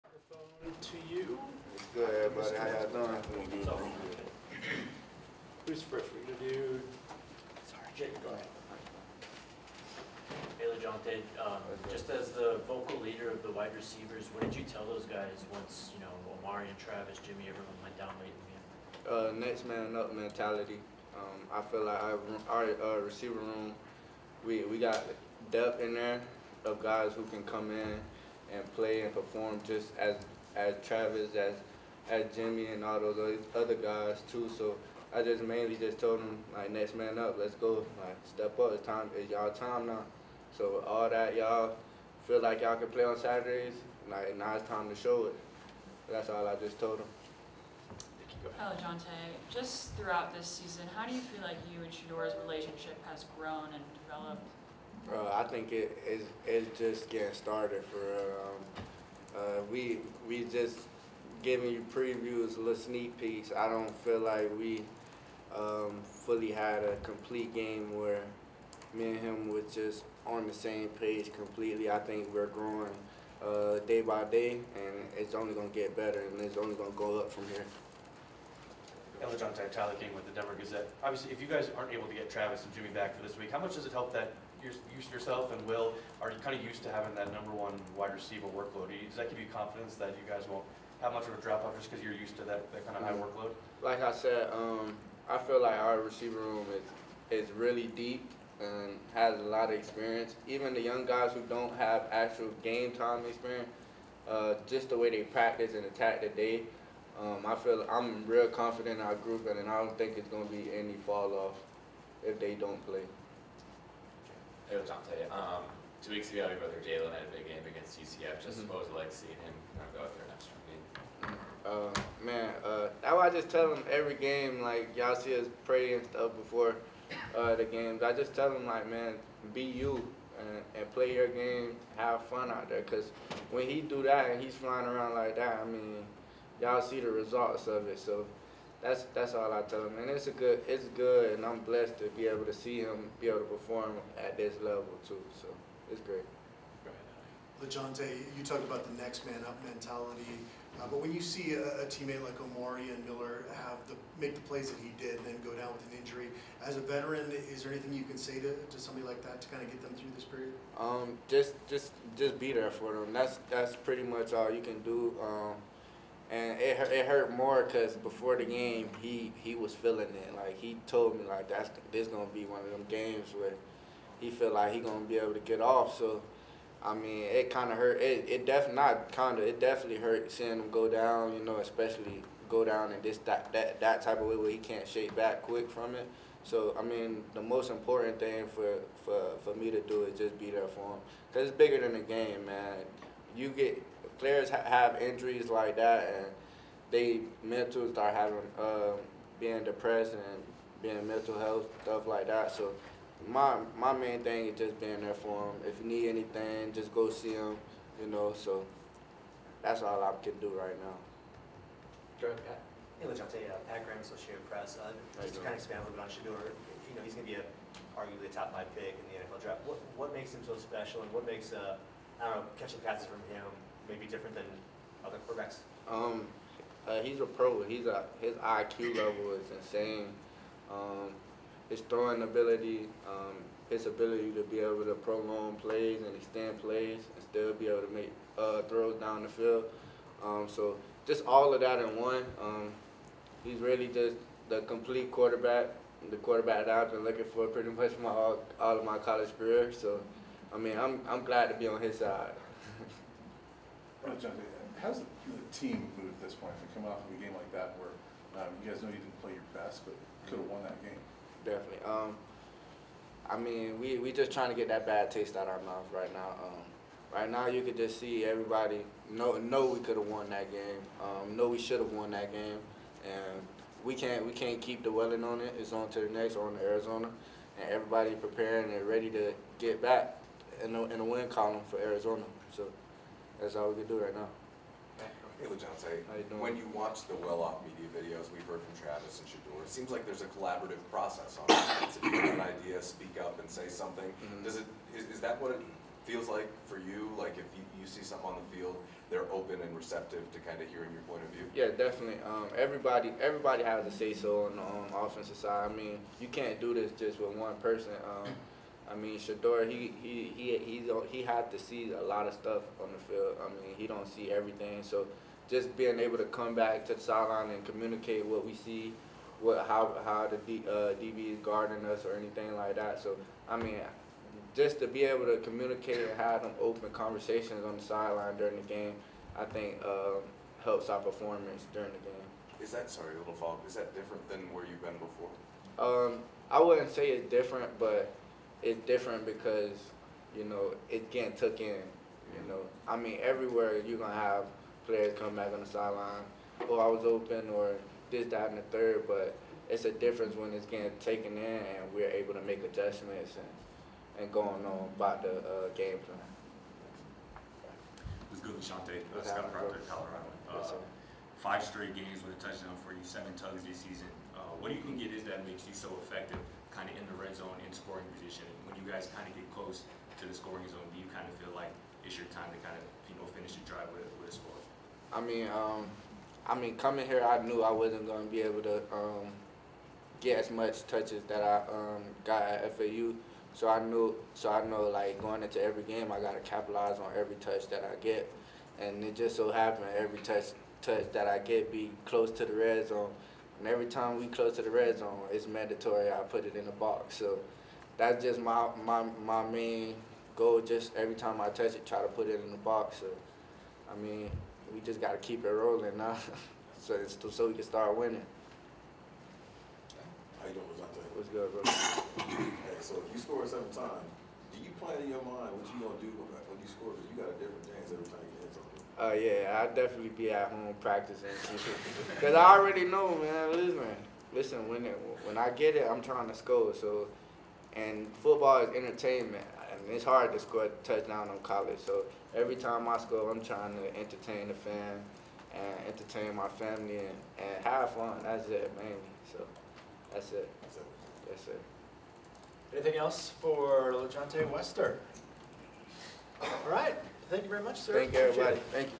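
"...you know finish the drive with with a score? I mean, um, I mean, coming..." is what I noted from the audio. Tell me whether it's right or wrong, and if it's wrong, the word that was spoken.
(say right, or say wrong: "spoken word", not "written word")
right.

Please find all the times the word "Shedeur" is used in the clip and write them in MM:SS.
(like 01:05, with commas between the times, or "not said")
00:51, 03:36, 04:49, 05:09.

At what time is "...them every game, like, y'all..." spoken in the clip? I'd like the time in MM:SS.
02:03.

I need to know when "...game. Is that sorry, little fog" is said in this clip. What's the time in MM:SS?
05:31.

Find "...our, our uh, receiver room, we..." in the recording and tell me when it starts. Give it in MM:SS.
00:22.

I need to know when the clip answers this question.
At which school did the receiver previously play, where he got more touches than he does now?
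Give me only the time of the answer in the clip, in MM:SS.
06:22.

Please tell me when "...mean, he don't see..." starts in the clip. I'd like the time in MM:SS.
05:13.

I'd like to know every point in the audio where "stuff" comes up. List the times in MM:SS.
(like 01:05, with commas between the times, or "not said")
02:06, 03:21, 05:12.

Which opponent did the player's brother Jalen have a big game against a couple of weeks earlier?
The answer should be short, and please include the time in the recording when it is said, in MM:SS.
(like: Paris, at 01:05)
UCF, at 01:57.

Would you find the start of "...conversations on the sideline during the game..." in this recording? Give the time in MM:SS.
05:26.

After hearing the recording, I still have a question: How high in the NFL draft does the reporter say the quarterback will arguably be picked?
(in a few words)
top 5.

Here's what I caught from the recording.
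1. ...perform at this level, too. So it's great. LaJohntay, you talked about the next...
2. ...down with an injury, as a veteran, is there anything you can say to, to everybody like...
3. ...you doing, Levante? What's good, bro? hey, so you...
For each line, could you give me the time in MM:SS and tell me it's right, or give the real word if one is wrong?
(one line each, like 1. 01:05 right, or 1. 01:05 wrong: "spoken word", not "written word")
1. 02:23 right
2. 02:35 wrong: "somebody", not "everybody"
3. 06:50 right.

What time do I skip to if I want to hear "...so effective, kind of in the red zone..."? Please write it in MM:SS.
06:05.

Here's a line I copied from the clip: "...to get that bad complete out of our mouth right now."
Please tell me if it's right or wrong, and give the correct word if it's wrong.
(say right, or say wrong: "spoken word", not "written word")
wrong: "taste", not "complete".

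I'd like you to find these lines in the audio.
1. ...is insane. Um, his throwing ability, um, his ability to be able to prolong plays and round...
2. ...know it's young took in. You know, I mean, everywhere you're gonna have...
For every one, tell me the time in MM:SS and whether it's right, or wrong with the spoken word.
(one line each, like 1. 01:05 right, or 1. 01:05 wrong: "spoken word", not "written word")
1. 03:49 wrong: "extend", not "round"
2. 05:40 wrong: "getting", not "young".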